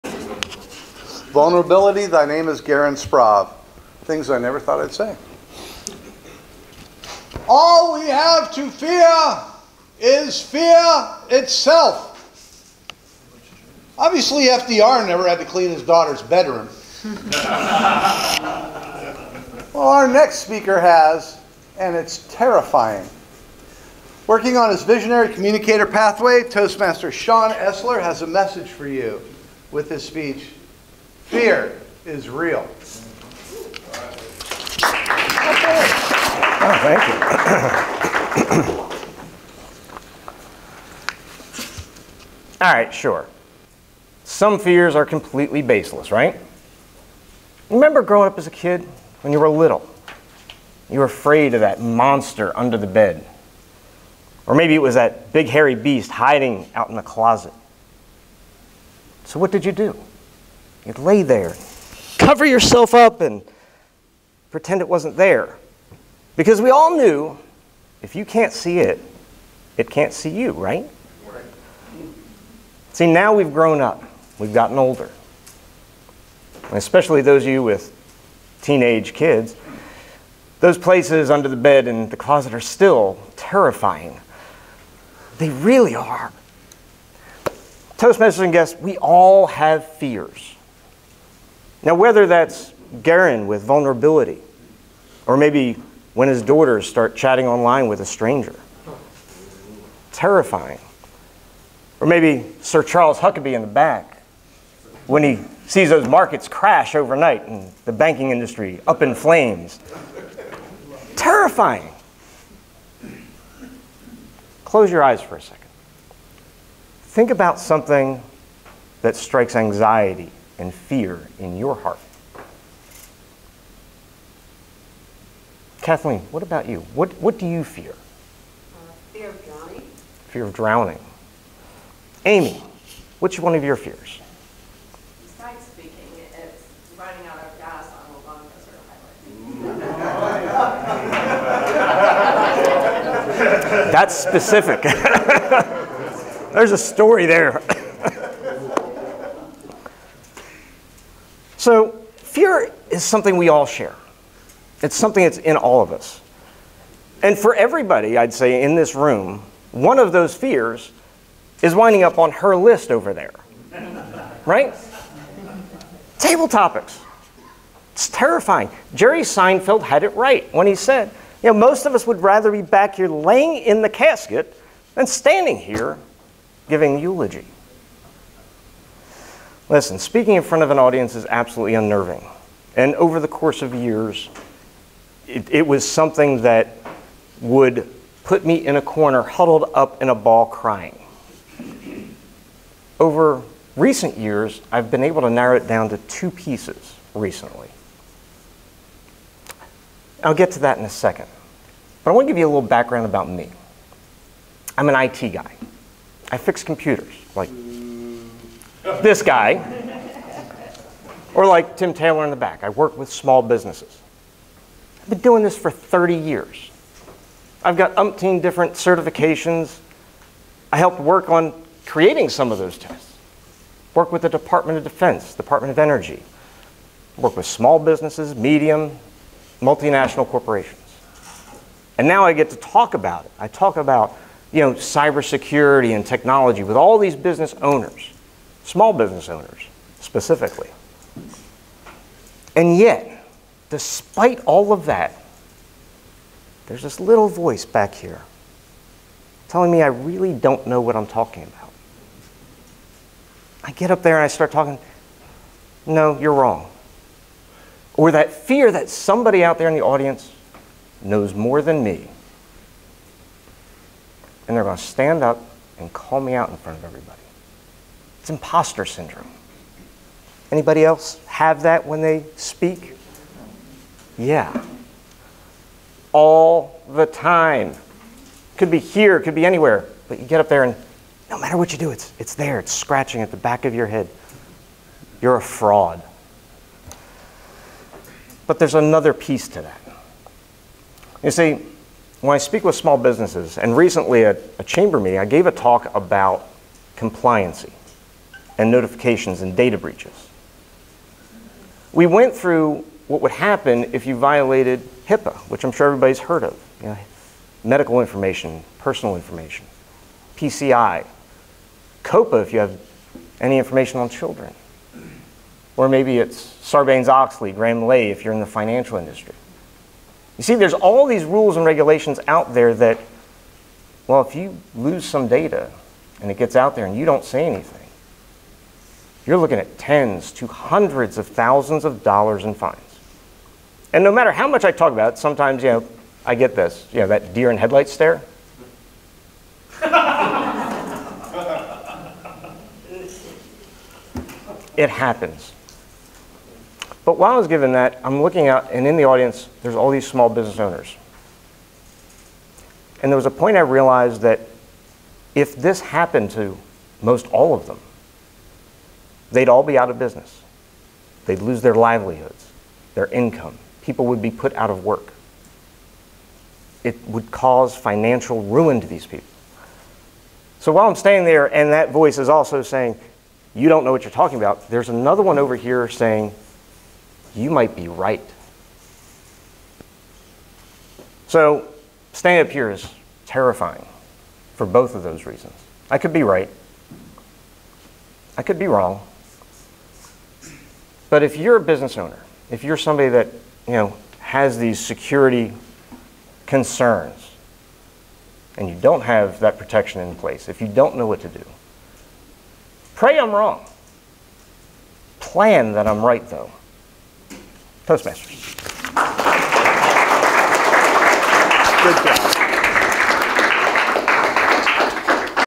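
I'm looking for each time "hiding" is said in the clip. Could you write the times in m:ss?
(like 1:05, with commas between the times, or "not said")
0:56.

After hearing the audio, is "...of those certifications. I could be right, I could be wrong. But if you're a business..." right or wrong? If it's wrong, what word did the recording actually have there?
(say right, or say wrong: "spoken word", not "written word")
wrong: "reasons", not "certifications".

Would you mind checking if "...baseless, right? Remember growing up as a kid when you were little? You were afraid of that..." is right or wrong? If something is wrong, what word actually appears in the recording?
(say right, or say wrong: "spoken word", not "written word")
right.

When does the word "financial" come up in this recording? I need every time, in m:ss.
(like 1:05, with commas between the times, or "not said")
5:18, 6:07.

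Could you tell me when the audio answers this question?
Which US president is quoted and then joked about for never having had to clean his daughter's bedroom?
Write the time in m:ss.
0:14.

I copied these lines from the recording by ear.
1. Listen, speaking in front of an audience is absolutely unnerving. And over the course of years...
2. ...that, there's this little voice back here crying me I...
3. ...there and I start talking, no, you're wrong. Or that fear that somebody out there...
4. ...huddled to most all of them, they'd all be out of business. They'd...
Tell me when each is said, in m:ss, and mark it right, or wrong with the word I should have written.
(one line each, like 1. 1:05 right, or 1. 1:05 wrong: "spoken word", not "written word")
1. 2:59 right
2. 4:04 wrong: "telling", not "crying"
3. 4:14 right
4. 5:55 wrong: "happened", not "huddled".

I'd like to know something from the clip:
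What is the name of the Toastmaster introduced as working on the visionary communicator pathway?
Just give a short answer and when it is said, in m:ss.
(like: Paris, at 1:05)
Sean Esler, at 0:27.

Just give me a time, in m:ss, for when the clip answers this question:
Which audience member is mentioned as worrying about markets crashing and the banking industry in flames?
1:42.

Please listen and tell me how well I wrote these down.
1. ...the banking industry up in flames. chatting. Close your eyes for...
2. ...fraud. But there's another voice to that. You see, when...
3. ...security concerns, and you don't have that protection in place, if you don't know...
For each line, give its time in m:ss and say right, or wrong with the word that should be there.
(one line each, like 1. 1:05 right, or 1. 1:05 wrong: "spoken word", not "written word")
1. 1:47 wrong: "terrifying", not "chatting"
2. 4:45 wrong: "piece", not "voice"
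3. 6:34 right.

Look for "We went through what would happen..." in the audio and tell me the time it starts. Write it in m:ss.
5:01.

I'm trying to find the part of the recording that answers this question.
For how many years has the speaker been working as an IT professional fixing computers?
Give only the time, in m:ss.
3:35.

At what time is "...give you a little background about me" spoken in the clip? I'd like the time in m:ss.
3:22.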